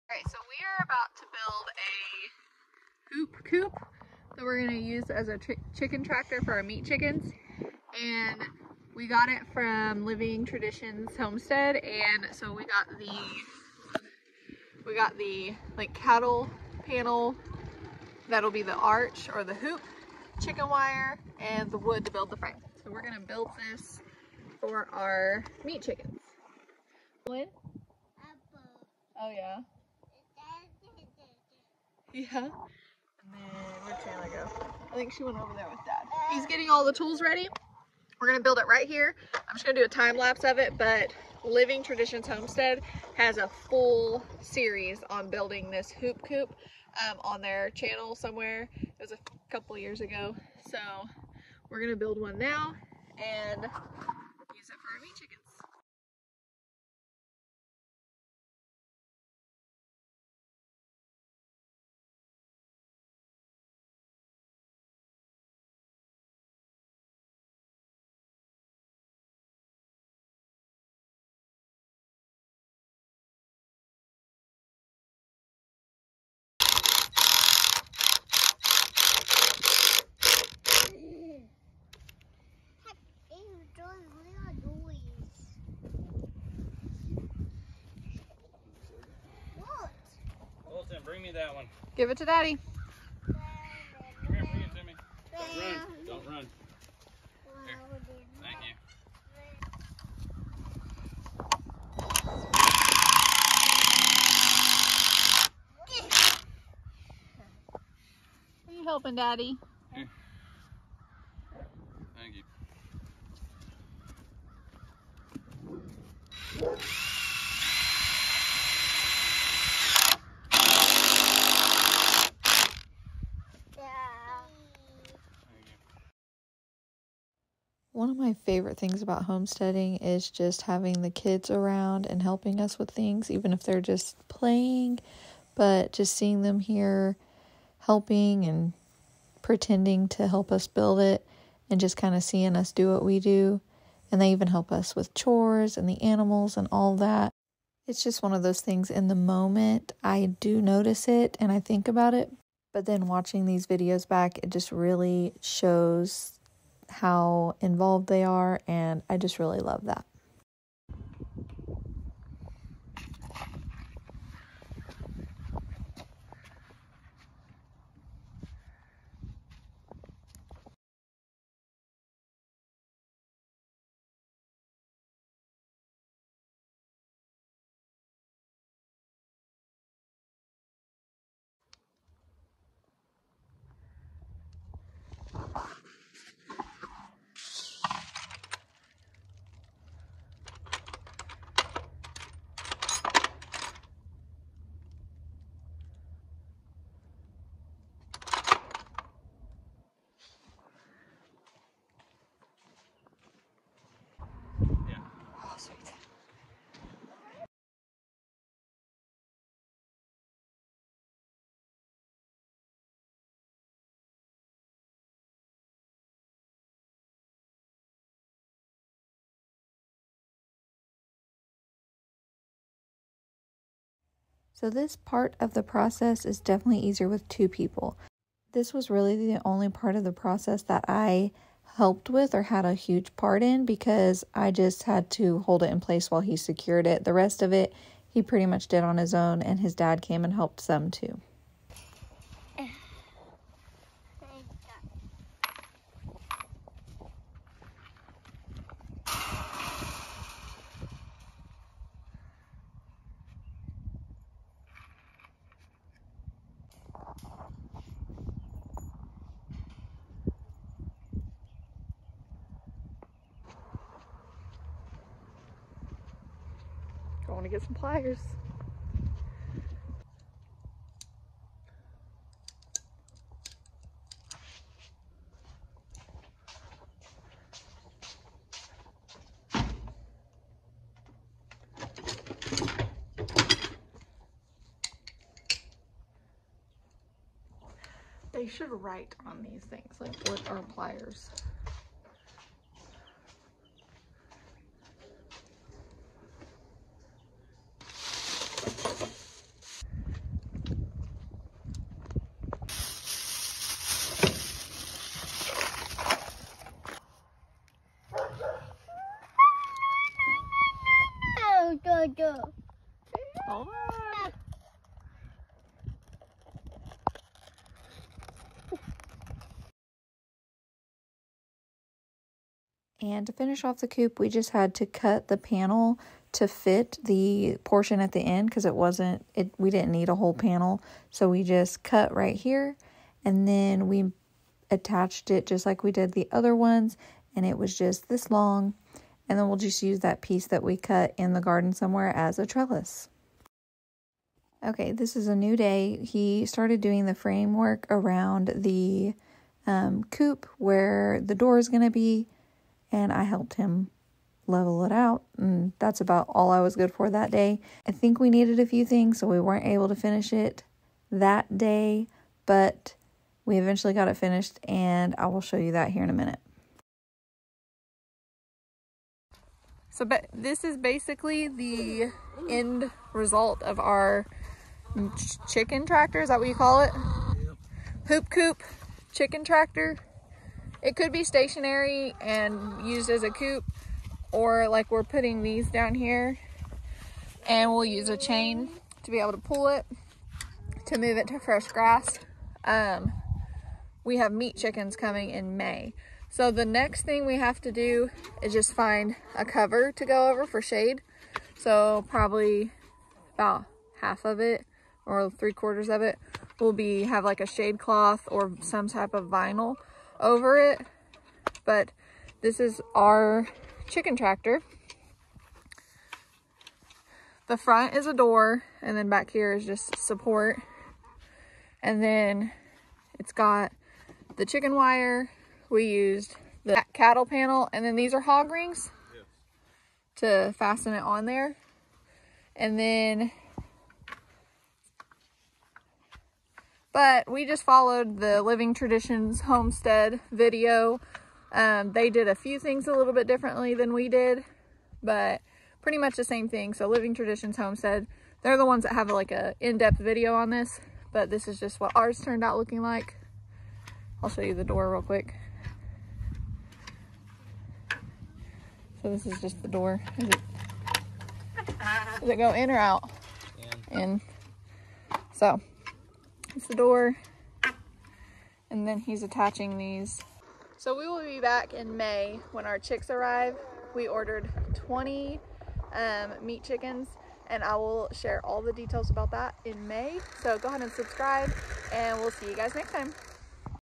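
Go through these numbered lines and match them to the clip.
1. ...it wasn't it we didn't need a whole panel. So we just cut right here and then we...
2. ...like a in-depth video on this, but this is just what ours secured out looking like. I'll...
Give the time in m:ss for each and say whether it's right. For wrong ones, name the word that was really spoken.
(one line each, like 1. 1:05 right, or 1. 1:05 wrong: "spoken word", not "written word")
1. 5:28 right
2. 7:29 wrong: "turned", not "secured".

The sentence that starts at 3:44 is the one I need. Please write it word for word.
So this part of the process is definitely easier with two people.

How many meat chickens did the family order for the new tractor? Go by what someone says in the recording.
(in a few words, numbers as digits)
20.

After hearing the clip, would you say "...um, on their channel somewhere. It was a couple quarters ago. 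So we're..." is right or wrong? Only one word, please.
wrong.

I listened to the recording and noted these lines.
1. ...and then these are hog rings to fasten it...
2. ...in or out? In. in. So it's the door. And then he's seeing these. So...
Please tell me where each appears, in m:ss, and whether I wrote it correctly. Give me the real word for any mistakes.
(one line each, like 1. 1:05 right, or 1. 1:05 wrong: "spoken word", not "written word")
1. 7:07 right
2. 7:42 wrong: "attaching", not "seeing".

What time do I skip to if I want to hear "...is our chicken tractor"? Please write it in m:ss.
6:52.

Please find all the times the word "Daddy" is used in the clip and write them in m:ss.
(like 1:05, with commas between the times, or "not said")
1:32, 1:49.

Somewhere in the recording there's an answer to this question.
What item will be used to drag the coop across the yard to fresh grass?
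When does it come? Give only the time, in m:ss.
6:28.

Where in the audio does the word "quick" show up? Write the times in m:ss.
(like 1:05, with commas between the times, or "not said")
7:35.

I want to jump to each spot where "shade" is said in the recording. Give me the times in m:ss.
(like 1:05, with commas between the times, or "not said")
6:40, 6:47.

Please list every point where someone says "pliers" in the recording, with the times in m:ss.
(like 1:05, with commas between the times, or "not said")
4:27, 4:50.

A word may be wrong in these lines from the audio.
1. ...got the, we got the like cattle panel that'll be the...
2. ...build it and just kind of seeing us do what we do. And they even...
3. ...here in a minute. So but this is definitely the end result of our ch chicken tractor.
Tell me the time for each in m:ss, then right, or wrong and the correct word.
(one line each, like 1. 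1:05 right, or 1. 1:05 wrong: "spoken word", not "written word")
1. 0:12 right
2. 2:20 right
3. 6:05 wrong: "basically", not "definitely".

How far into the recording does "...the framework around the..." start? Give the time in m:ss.
5:47.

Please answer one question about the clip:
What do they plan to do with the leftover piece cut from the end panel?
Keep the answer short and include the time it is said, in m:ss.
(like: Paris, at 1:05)
trellis, at 5:42.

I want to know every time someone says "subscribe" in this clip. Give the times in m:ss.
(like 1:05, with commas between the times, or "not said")
8:00.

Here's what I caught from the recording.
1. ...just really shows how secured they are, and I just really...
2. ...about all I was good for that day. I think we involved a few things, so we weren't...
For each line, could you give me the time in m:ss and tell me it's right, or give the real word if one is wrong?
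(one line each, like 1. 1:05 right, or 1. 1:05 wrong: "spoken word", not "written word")
1. 2:34 wrong: "involved", not "secured"
2. 5:56 wrong: "needed", not "involved".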